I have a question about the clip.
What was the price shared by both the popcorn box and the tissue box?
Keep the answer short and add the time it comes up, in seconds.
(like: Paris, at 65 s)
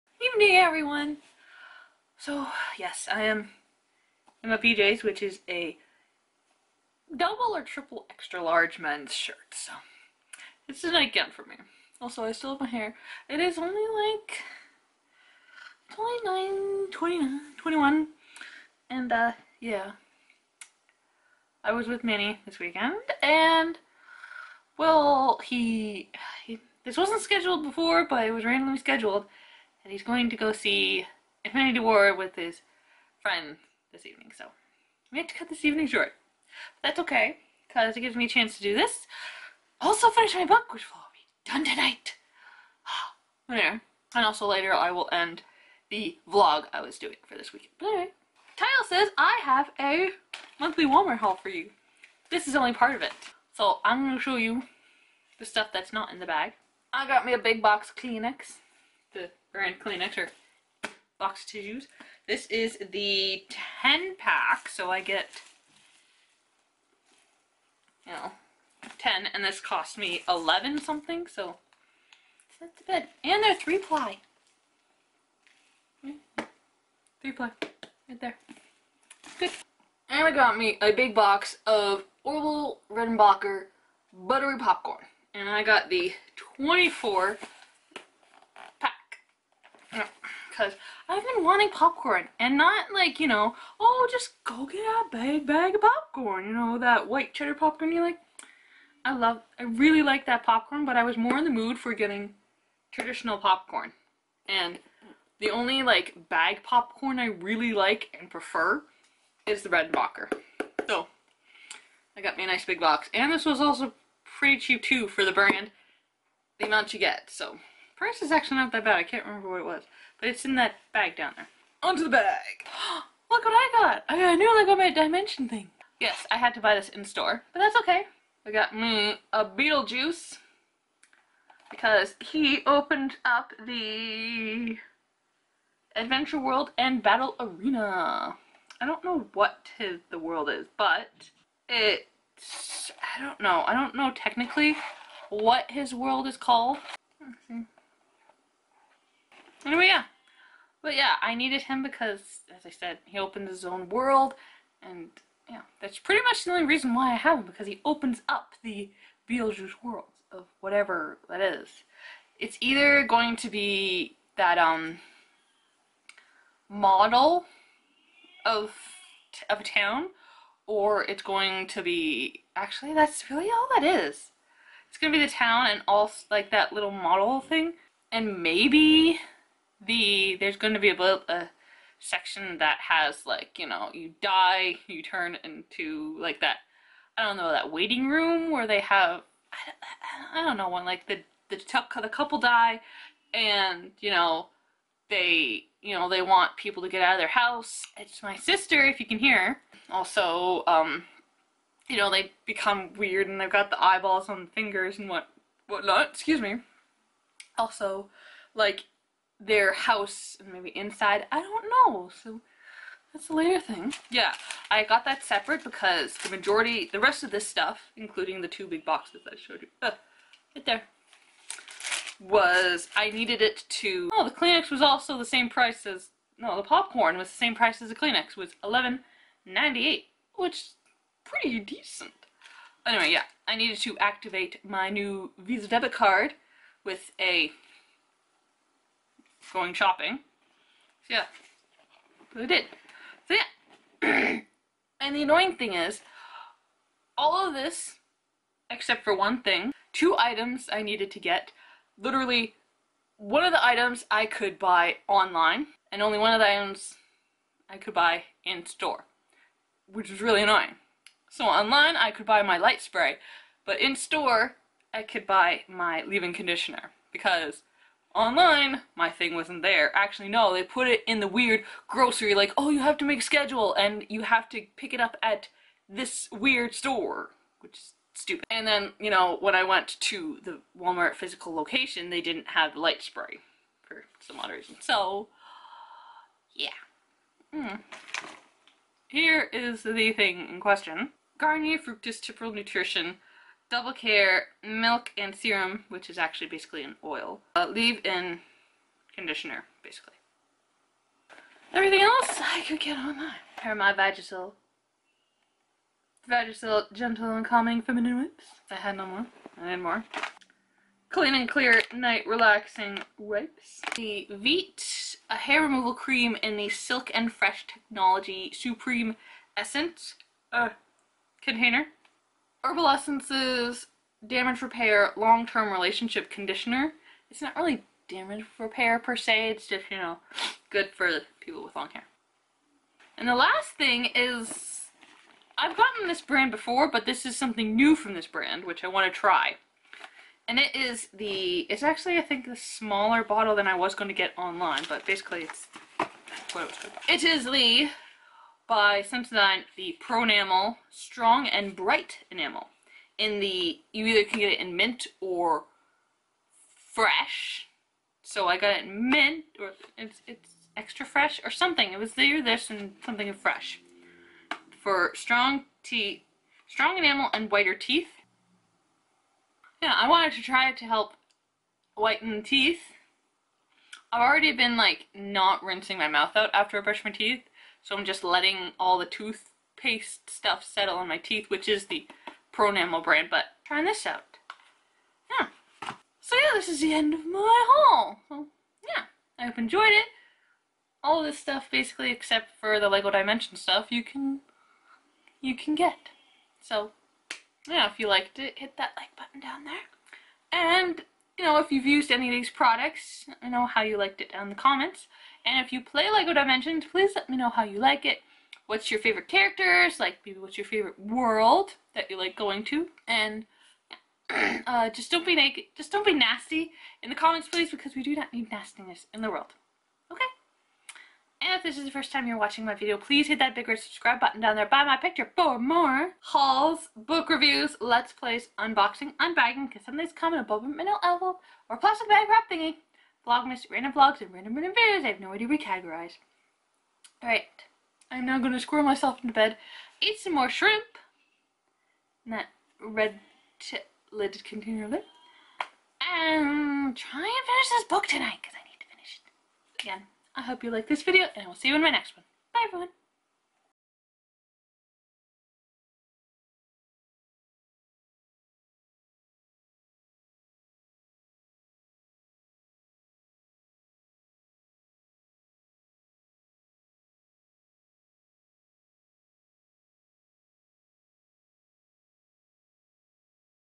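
$11.98, at 228 s.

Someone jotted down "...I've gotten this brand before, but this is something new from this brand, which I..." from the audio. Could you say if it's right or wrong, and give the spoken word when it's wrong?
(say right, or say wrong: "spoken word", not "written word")
right.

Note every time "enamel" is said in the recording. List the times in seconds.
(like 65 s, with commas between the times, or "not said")
352 s, 366 s.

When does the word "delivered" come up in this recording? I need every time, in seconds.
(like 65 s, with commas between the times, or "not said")
not said.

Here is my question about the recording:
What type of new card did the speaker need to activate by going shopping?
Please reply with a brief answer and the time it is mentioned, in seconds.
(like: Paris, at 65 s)
Visa debit card, at 235 s.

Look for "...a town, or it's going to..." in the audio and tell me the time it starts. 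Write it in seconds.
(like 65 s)
169 s.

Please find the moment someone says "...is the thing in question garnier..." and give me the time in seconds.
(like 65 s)
289 s.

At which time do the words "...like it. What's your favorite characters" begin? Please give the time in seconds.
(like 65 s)
407 s.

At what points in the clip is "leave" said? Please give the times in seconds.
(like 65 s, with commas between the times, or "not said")
266 s, 297 s.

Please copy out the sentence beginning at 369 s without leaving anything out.
Yeah, I wanted to try it to help whiten teeth.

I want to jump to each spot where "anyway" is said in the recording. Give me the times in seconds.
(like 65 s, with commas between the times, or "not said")
43 s, 47 s, 149 s, 232 s.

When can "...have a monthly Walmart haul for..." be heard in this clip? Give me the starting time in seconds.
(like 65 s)
49 s.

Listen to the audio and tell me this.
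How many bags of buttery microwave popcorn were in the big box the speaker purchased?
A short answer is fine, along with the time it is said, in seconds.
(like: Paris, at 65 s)
24, at 86 s.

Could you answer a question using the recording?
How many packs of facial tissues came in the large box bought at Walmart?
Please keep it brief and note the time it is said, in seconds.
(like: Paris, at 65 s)
10, at 63 s.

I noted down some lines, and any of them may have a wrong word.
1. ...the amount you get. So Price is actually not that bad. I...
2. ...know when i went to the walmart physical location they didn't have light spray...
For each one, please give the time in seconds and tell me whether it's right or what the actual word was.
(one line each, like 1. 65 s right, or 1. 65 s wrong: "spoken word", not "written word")
1. 116 s right
2. 279 s right.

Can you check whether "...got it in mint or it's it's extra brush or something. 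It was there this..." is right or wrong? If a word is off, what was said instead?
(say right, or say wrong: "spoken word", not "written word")
wrong: "fresh", not "brush".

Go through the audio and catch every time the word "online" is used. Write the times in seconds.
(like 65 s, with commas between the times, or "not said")
255 s, 261 s, 268 s, 302 s, 344 s.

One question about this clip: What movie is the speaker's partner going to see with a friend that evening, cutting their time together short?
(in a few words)
Infinity War.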